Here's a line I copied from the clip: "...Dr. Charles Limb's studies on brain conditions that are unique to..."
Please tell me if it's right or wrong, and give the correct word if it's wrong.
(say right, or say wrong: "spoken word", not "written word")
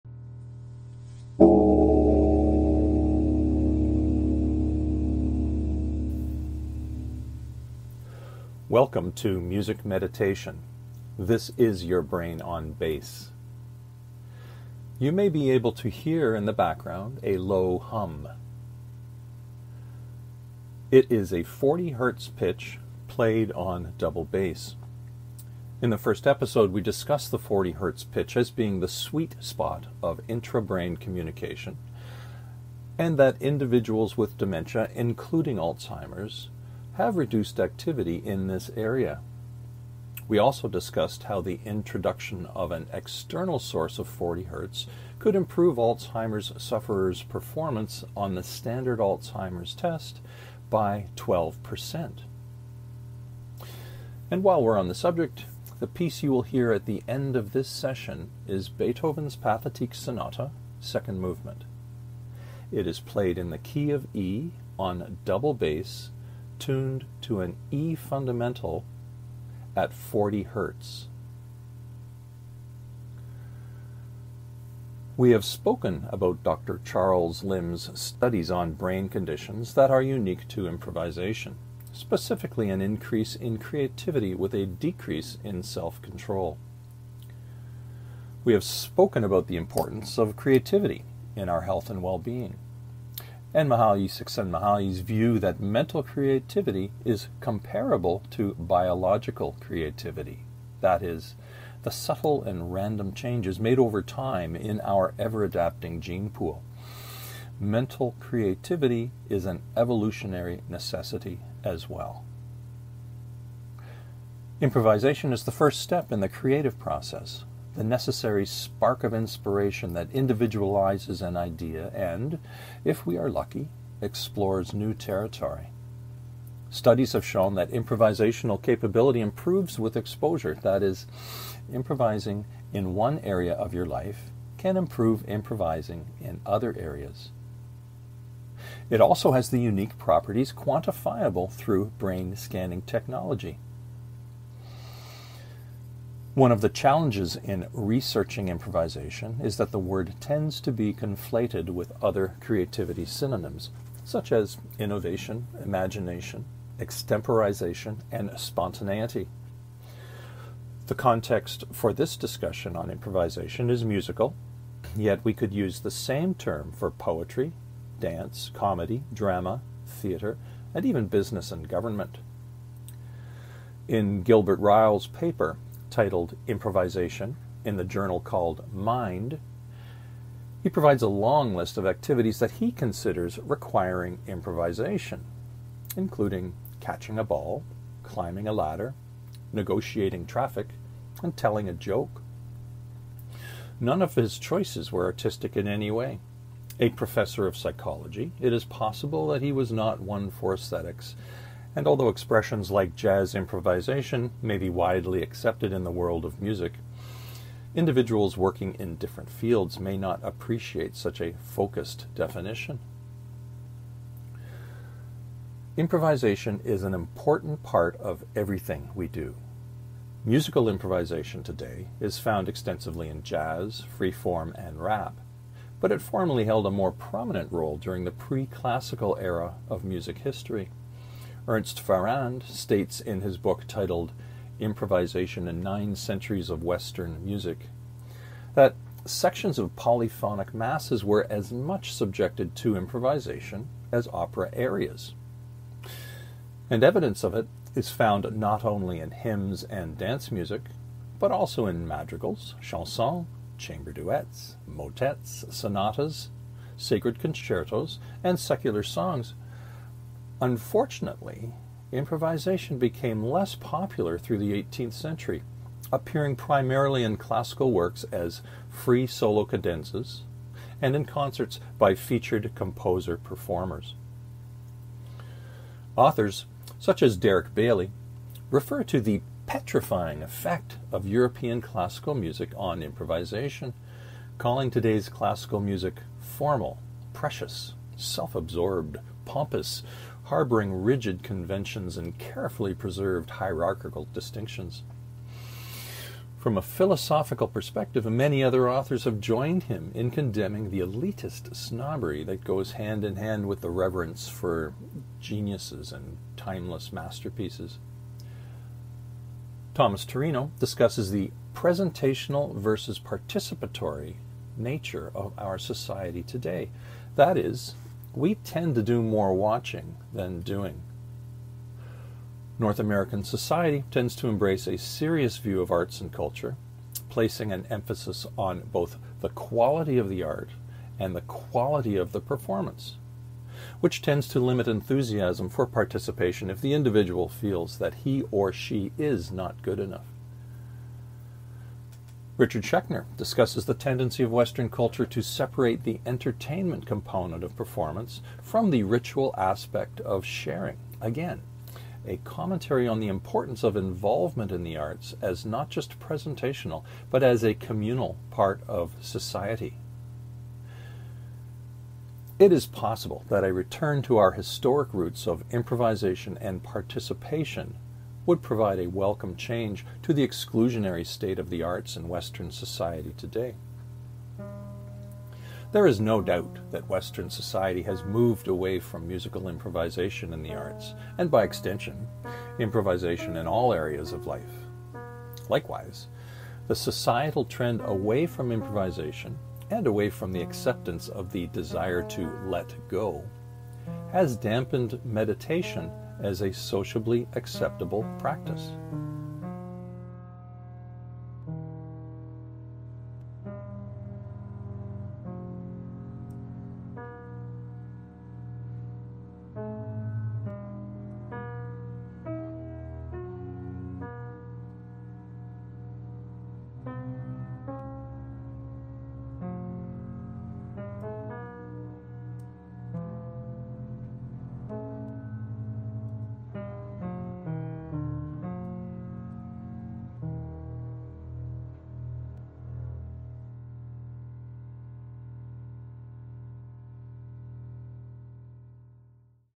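right.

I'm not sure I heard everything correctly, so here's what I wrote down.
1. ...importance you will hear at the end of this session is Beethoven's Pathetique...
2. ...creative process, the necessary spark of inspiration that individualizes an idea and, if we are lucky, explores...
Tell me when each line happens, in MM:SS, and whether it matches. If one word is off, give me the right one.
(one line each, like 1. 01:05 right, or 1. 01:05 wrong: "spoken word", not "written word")
1. 00:55 wrong: "piece", not "importance"
2. 01:56 right.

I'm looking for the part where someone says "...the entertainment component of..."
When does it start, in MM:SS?
05:45.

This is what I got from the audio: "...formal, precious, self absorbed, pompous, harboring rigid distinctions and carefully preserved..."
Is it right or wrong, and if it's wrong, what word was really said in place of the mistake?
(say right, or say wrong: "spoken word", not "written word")
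wrong: "conventions", not "distinctions".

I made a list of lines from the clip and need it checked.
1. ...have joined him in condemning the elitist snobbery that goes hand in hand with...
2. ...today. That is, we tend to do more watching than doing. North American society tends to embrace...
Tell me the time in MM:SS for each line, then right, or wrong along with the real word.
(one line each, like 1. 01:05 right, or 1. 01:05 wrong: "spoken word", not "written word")
1. 04:59 right
2. 05:16 right.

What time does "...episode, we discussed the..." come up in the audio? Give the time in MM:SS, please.
00:26.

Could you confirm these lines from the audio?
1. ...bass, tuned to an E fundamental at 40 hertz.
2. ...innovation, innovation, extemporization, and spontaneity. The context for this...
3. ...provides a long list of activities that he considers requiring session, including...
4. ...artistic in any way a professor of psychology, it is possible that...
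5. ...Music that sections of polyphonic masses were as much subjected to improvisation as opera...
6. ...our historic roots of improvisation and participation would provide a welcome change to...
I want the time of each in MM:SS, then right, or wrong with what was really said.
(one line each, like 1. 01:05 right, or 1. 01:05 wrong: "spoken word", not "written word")
1. 01:05 right
2. 02:34 wrong: "imagination", not "innovation"
3. 03:00 wrong: "improvisation", not "session"
4. 03:15 right
5. 03:57 right
6. 06:04 right.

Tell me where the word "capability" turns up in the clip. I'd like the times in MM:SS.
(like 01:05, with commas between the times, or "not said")
02:08.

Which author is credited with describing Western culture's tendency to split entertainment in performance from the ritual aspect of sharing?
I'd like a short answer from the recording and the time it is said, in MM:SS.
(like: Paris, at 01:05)
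Richard Schechner, at 05:42.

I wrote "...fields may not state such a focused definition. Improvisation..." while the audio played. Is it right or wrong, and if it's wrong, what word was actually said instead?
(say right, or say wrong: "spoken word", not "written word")
wrong: "appreciate", not "state".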